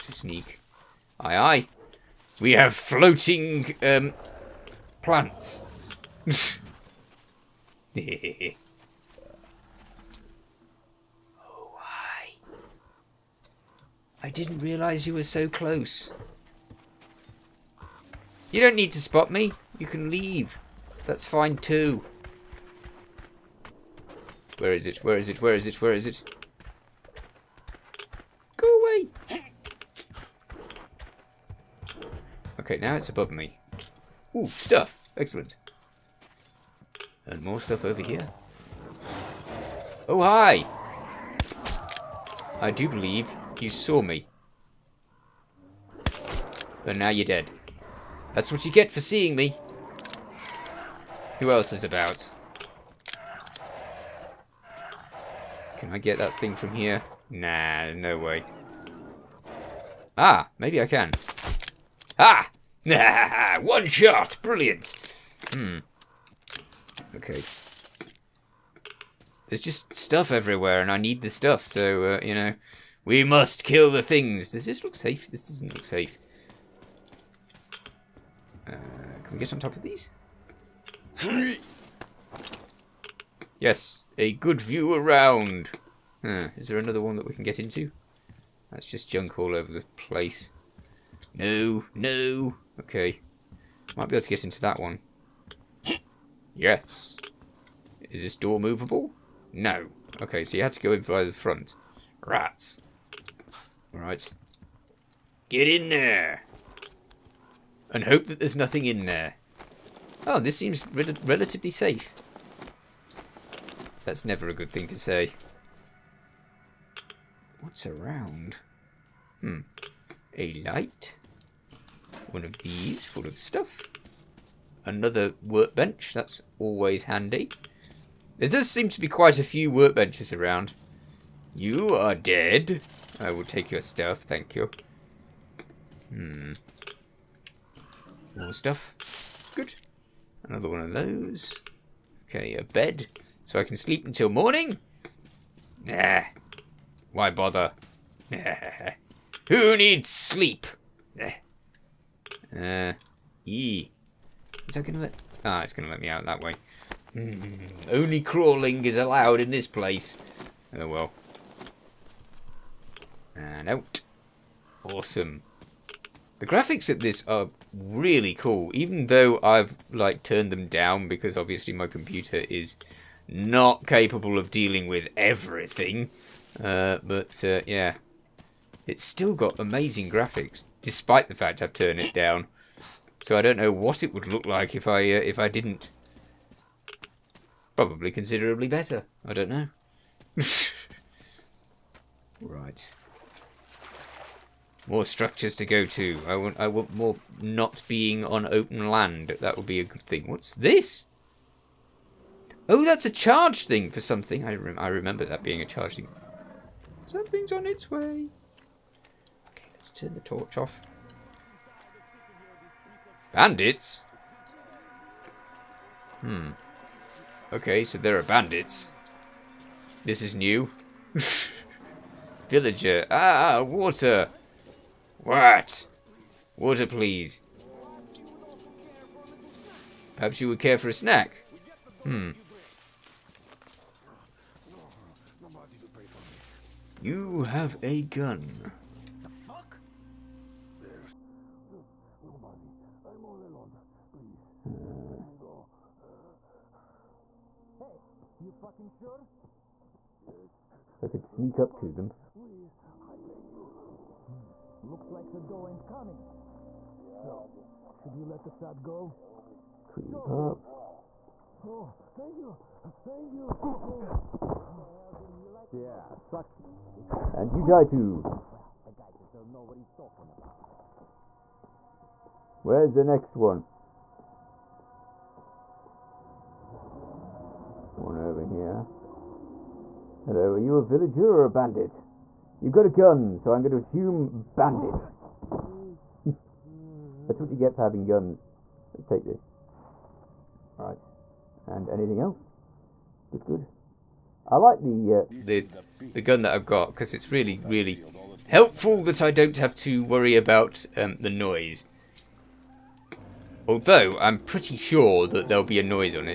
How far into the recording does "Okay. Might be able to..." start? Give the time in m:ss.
1:32.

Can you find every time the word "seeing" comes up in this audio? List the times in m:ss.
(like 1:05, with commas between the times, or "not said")
0:49.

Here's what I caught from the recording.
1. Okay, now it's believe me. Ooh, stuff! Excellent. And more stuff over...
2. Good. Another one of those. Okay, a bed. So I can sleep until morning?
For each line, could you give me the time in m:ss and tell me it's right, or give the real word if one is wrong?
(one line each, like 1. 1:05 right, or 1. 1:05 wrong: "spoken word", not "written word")
1. 0:32 wrong: "above", not "believe"
2. 2:19 right.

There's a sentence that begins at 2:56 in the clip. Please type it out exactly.
Uh, but uh, yeah, it's still got amazing graphics, despite the fact I've turned it down.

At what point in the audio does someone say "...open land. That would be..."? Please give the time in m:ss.
3:18.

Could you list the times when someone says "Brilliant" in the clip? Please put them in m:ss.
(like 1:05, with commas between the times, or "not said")
1:04.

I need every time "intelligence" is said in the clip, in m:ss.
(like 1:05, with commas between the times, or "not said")
not said.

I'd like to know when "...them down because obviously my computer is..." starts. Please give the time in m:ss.
2:50.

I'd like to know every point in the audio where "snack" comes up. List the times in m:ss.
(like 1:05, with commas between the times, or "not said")
3:50.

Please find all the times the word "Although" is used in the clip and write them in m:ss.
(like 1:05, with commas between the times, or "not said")
5:03.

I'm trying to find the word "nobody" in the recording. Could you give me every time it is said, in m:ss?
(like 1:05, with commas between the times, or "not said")
4:02.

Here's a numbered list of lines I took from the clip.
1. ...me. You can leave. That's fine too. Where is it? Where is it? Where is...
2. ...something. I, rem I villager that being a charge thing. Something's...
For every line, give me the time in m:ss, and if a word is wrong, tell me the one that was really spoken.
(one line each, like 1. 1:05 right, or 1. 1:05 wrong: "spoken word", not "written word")
1. 0:19 right
2. 3:23 wrong: "remember", not "villager".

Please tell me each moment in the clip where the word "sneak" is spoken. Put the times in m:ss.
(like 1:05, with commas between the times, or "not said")
0:00, 4:11.